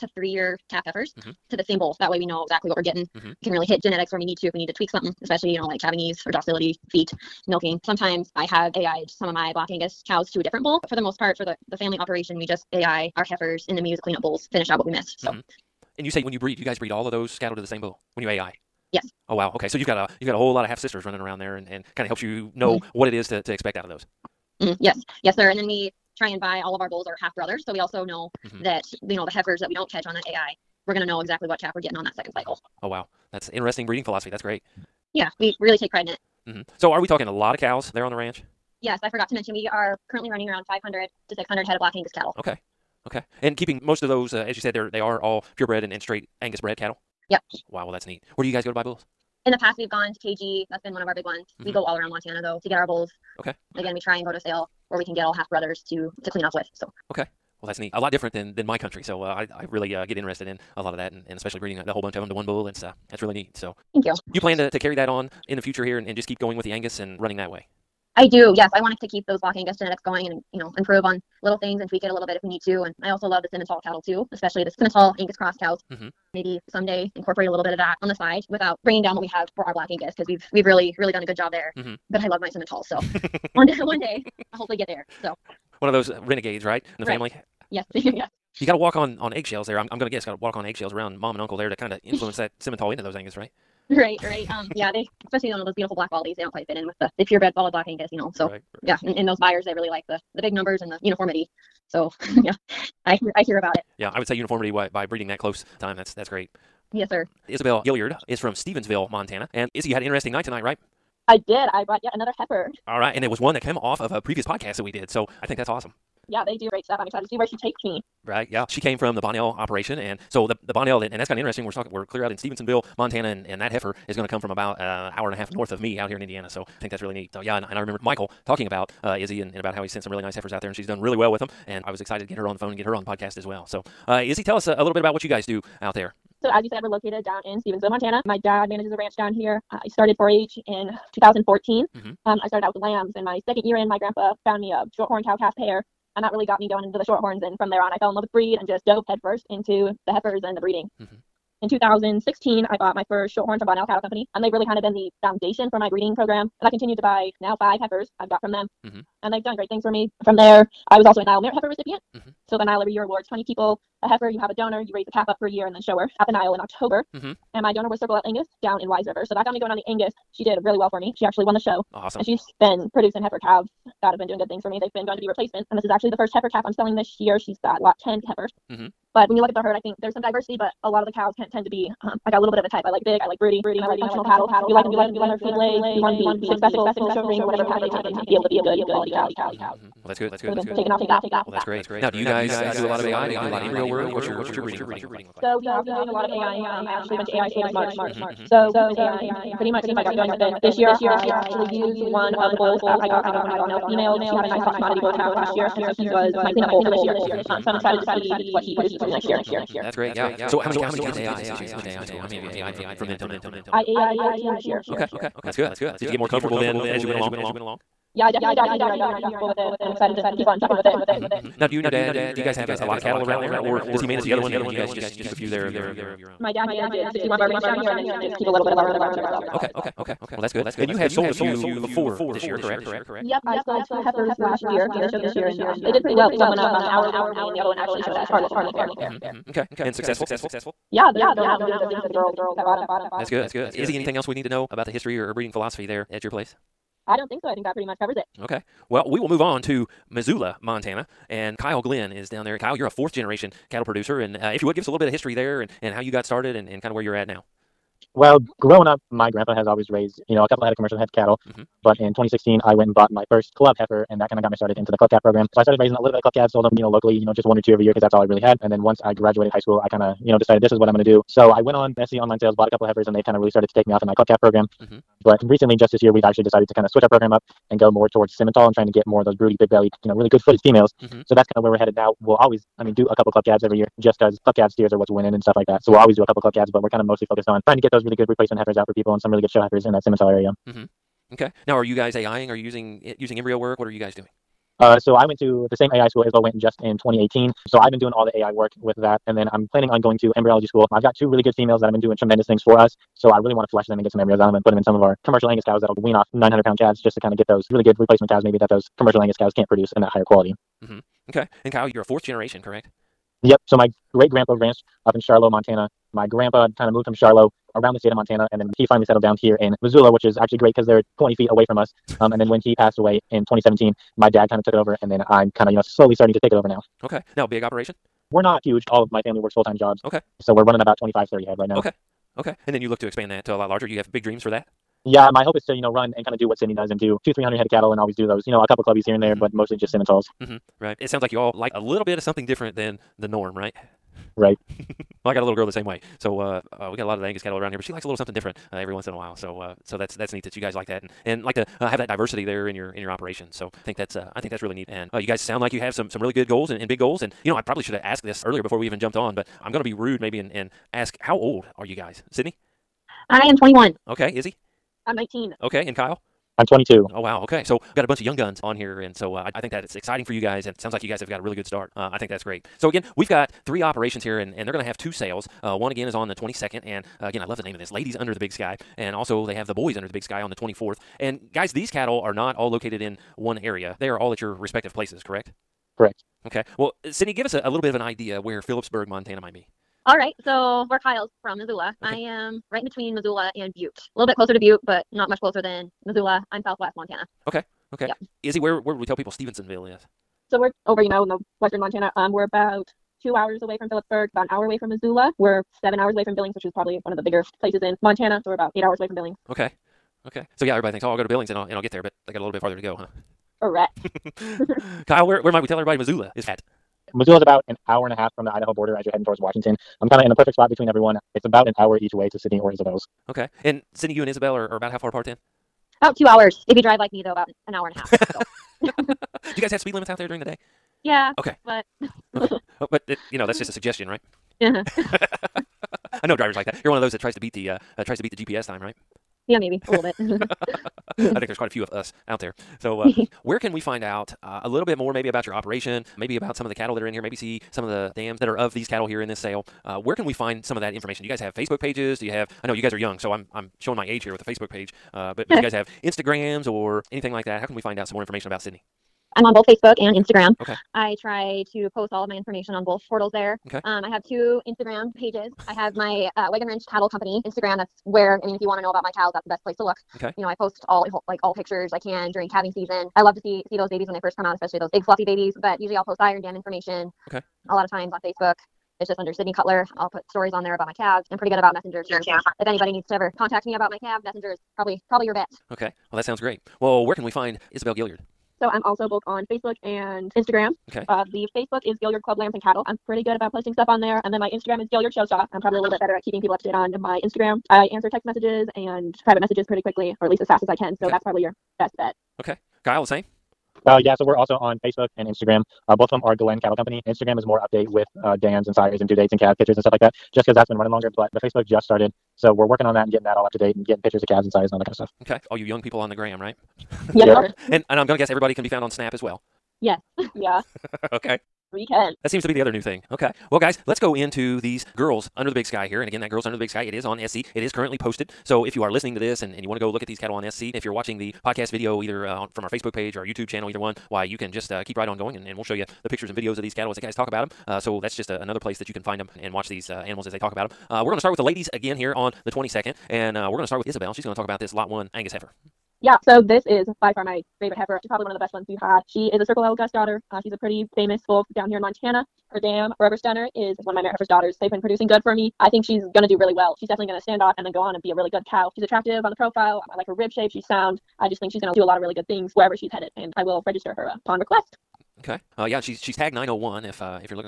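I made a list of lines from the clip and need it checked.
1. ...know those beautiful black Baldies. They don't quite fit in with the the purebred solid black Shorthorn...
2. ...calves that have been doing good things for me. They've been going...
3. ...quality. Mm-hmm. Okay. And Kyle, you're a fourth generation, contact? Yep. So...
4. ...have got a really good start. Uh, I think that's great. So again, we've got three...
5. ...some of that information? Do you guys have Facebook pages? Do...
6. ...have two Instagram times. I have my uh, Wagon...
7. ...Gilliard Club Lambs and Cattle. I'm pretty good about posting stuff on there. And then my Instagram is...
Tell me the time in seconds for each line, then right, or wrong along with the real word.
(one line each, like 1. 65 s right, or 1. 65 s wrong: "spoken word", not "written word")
1. 95 s wrong: "Angus", not "Shorthorn"
2. 173 s right
3. 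310 s wrong: "correct", not "contact"
4. 371 s right
5. 450 s right
6. 464 s wrong: "pages", not "times"
7. 492 s right.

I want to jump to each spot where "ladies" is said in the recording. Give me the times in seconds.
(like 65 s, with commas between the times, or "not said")
377 s, 541 s.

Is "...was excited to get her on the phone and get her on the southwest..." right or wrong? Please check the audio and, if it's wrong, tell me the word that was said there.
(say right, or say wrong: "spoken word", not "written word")
wrong: "podcast", not "southwest".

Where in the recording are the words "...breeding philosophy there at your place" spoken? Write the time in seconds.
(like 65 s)
245 s.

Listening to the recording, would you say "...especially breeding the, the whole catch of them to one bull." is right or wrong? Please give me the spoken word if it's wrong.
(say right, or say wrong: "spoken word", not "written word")
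wrong: "bunch", not "catch".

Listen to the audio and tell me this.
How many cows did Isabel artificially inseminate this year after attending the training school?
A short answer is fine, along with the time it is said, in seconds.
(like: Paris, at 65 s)
14, at 214 s.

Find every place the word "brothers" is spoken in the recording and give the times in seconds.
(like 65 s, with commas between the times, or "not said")
27 s, 55 s.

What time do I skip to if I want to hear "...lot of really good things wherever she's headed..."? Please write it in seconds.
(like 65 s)
561 s.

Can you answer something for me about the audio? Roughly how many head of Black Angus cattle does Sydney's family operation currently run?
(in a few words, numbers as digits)
500 to 600.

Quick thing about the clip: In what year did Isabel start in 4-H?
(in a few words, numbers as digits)
2014.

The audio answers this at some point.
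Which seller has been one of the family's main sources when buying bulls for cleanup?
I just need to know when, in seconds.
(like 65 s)
50 s.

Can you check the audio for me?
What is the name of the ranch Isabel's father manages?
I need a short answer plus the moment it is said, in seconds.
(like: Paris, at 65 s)
61 Bar Ranch, at 227 s.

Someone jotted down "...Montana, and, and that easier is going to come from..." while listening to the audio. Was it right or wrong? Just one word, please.
wrong.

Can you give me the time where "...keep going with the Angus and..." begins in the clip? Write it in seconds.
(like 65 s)
66 s.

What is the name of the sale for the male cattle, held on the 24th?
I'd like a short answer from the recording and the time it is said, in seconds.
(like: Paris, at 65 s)
Boys Under the Big Sky, at 379 s.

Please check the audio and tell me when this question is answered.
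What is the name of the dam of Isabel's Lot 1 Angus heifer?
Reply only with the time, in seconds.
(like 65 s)
552 s.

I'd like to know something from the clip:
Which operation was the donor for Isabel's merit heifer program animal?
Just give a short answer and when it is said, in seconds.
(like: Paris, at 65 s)
Circle L Angus, at 167 s.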